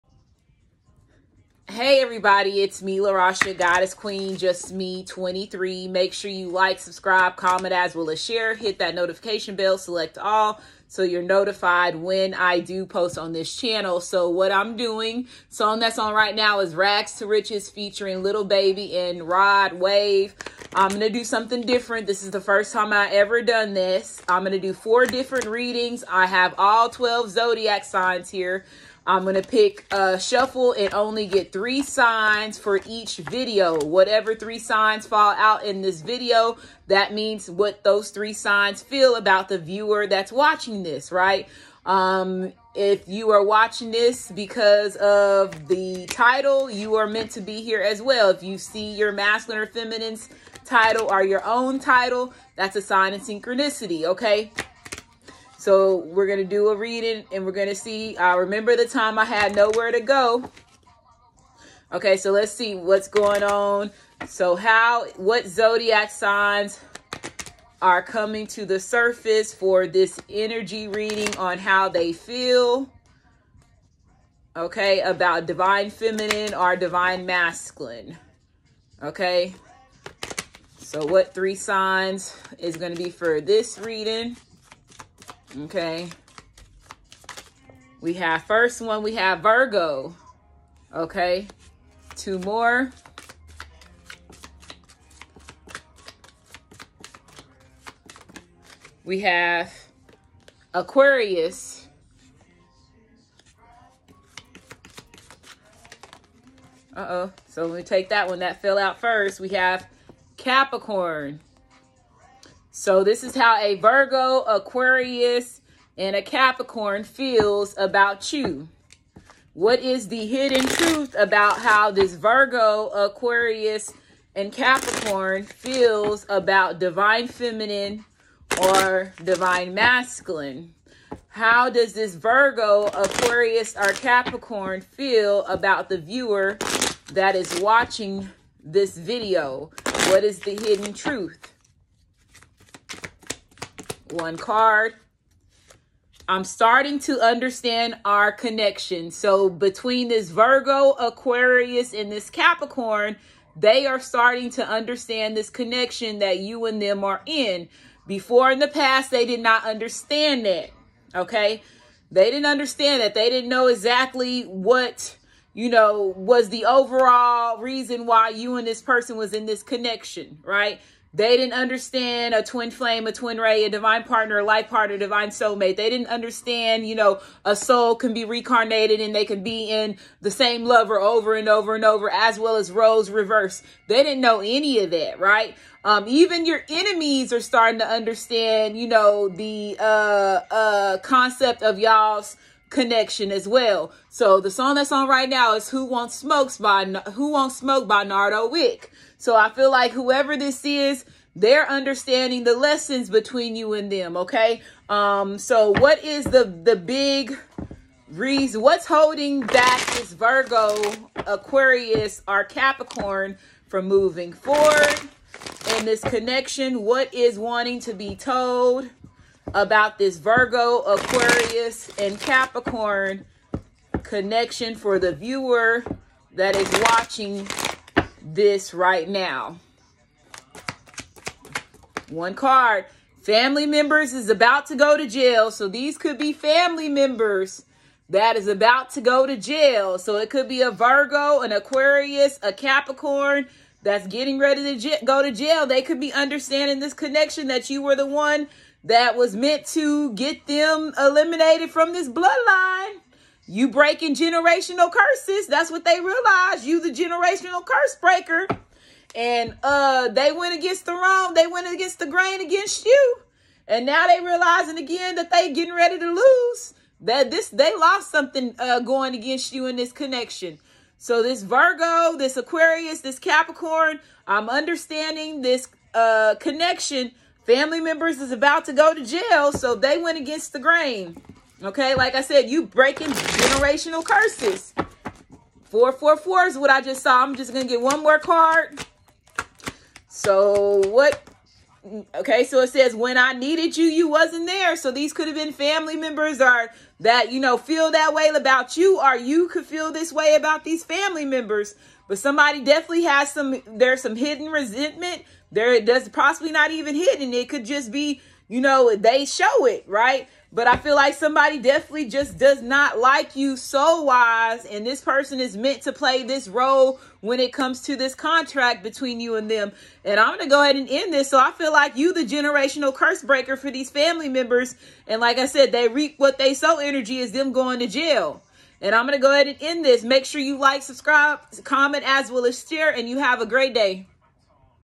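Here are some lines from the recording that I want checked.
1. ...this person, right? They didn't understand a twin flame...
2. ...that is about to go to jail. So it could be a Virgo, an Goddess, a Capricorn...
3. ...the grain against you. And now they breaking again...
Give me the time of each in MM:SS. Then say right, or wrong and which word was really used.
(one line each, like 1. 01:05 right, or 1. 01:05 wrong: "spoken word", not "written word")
1. 02:49 wrong: "connection", not "person"
2. 03:58 wrong: "Aquarius", not "Goddess"
3. 04:21 wrong: "realizing", not "breaking".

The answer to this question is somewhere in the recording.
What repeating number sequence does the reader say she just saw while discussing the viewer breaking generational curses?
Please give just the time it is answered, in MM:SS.
04:45.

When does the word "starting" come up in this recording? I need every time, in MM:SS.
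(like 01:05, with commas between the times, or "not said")
02:26, 02:33, 03:07.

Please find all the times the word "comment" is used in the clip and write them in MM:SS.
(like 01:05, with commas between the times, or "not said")
00:07, 05:31.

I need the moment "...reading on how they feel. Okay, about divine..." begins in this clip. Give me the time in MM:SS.
01:10.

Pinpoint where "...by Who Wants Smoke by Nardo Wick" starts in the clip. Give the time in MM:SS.
03:16.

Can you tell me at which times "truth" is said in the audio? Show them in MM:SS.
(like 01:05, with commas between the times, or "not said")
02:00, 02:20.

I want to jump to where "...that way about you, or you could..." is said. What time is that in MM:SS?
04:57.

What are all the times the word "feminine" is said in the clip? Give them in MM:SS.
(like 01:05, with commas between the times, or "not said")
00:49, 01:15, 02:07.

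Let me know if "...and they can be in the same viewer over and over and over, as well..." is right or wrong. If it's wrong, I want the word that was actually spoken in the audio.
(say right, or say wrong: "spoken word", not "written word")
wrong: "lover", not "viewer".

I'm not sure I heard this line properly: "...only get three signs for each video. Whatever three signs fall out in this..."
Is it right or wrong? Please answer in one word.
right.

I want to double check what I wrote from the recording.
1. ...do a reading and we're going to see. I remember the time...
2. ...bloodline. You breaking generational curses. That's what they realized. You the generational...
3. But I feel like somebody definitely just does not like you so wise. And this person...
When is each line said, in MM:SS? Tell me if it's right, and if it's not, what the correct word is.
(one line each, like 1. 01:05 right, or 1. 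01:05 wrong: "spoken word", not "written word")
1. 00:56 right
2. 04:12 right
3. 05:10 right.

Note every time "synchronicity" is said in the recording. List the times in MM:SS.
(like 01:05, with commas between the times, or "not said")
00:53.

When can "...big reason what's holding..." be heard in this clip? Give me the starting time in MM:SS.
03:26.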